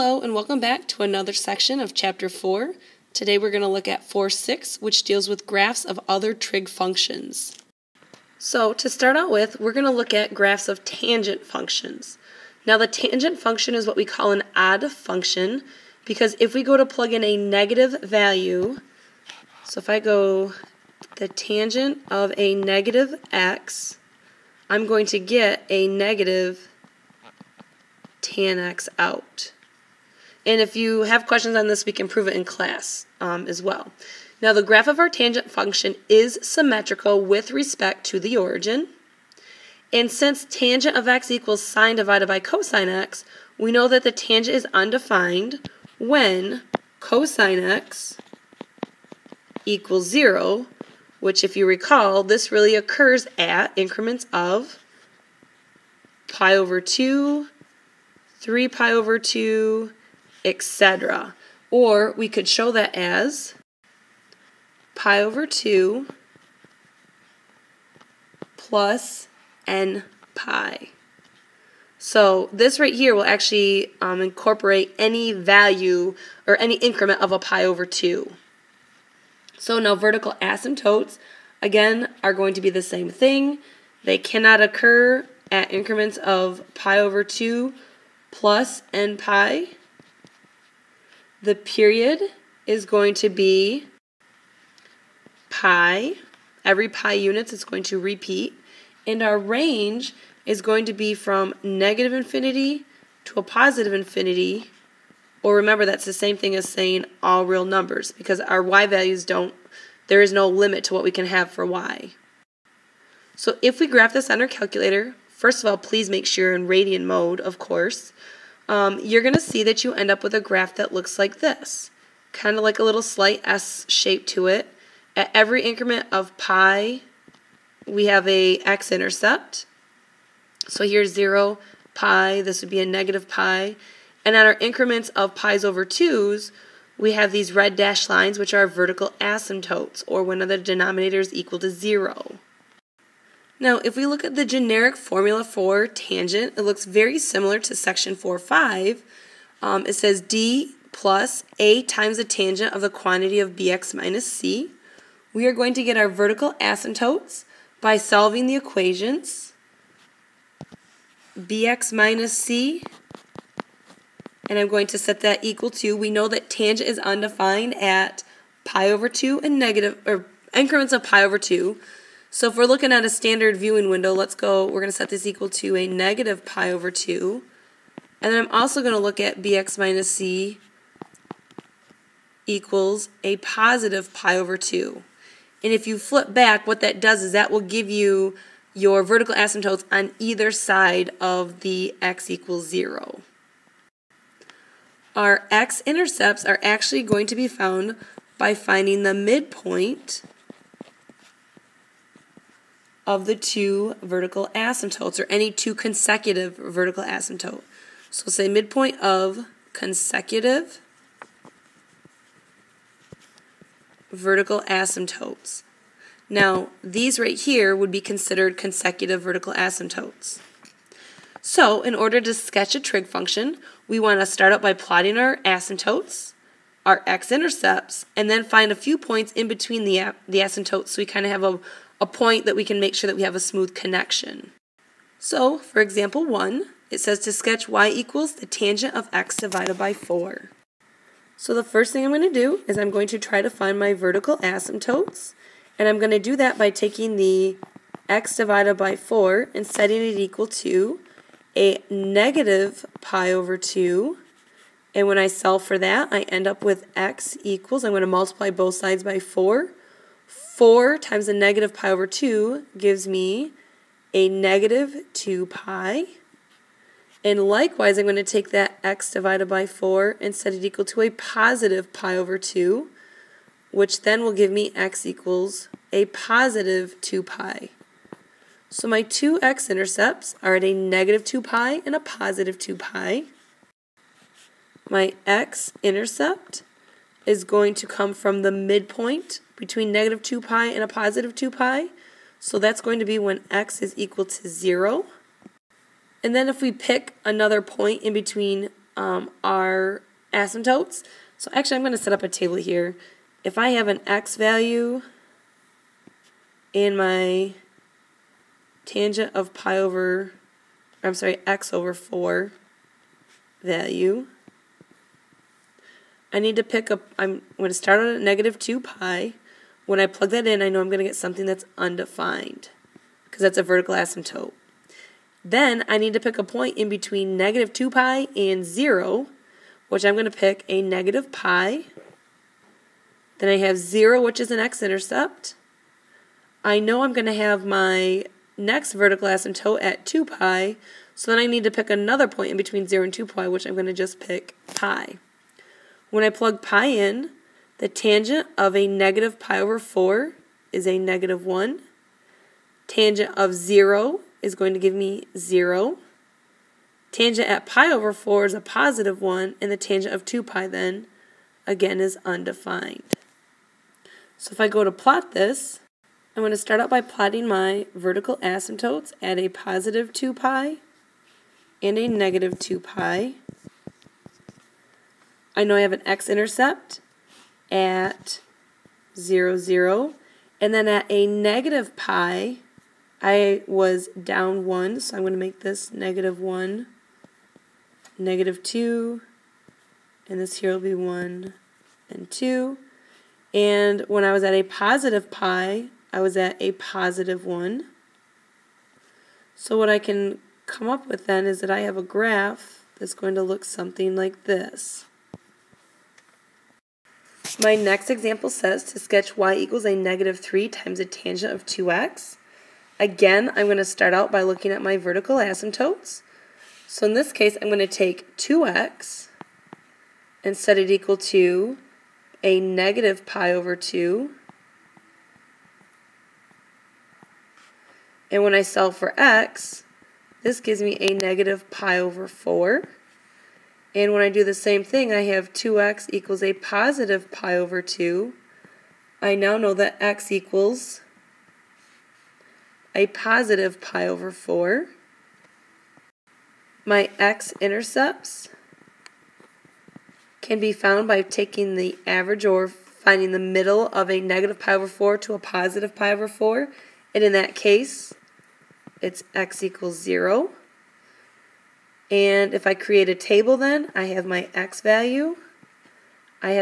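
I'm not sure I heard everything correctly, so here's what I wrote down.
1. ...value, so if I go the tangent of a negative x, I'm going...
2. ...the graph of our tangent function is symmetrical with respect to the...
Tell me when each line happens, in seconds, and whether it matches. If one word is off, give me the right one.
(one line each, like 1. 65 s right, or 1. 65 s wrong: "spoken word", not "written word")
1. 18 s right
2. 34 s right.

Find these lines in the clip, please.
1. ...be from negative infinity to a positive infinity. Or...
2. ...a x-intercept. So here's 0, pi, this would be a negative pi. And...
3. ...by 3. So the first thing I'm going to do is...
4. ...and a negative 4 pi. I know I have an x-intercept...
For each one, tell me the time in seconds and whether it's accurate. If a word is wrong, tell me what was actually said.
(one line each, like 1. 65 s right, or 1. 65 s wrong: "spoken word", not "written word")
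1. 100 s right
2. 128 s right
3. 239 s wrong: "4", not "3"
4. 371 s wrong: "2", not "4".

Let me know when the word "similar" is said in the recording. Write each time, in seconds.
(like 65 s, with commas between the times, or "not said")
147 s.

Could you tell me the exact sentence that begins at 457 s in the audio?
And in that case, it's x equals 0.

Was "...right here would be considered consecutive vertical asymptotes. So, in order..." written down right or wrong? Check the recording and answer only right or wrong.
right.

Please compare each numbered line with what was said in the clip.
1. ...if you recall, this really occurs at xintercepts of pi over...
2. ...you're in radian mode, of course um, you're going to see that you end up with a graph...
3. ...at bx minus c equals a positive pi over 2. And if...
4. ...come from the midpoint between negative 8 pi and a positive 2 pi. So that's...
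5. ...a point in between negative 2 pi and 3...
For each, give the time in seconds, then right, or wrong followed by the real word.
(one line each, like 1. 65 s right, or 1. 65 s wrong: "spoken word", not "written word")
1. 51 s wrong: "increments", not "xintercepts"
2. 116 s right
3. 179 s right
4. 287 s wrong: "2", not "8"
5. 326 s wrong: "0", not "3".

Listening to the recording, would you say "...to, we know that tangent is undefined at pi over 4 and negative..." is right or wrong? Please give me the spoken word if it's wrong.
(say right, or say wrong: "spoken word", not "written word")
wrong: "2", not "4".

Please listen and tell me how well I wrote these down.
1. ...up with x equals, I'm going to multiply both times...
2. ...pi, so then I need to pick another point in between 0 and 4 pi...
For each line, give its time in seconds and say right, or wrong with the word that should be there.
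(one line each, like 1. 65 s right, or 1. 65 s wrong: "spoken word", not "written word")
1. 256 s wrong: "sides", not "times"
2. 340 s wrong: "2", not "4".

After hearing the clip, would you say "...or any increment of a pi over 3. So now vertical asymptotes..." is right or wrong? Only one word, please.
wrong.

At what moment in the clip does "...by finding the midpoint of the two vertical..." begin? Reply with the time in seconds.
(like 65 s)
198 s.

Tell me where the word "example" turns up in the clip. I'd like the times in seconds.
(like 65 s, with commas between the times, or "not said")
235 s, 408 s.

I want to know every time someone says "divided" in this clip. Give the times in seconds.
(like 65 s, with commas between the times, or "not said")
41 s, 239 s, 248 s, 269 s.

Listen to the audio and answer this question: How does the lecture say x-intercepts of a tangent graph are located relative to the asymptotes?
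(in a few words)
midpoint of consecutive vertical asymptotes.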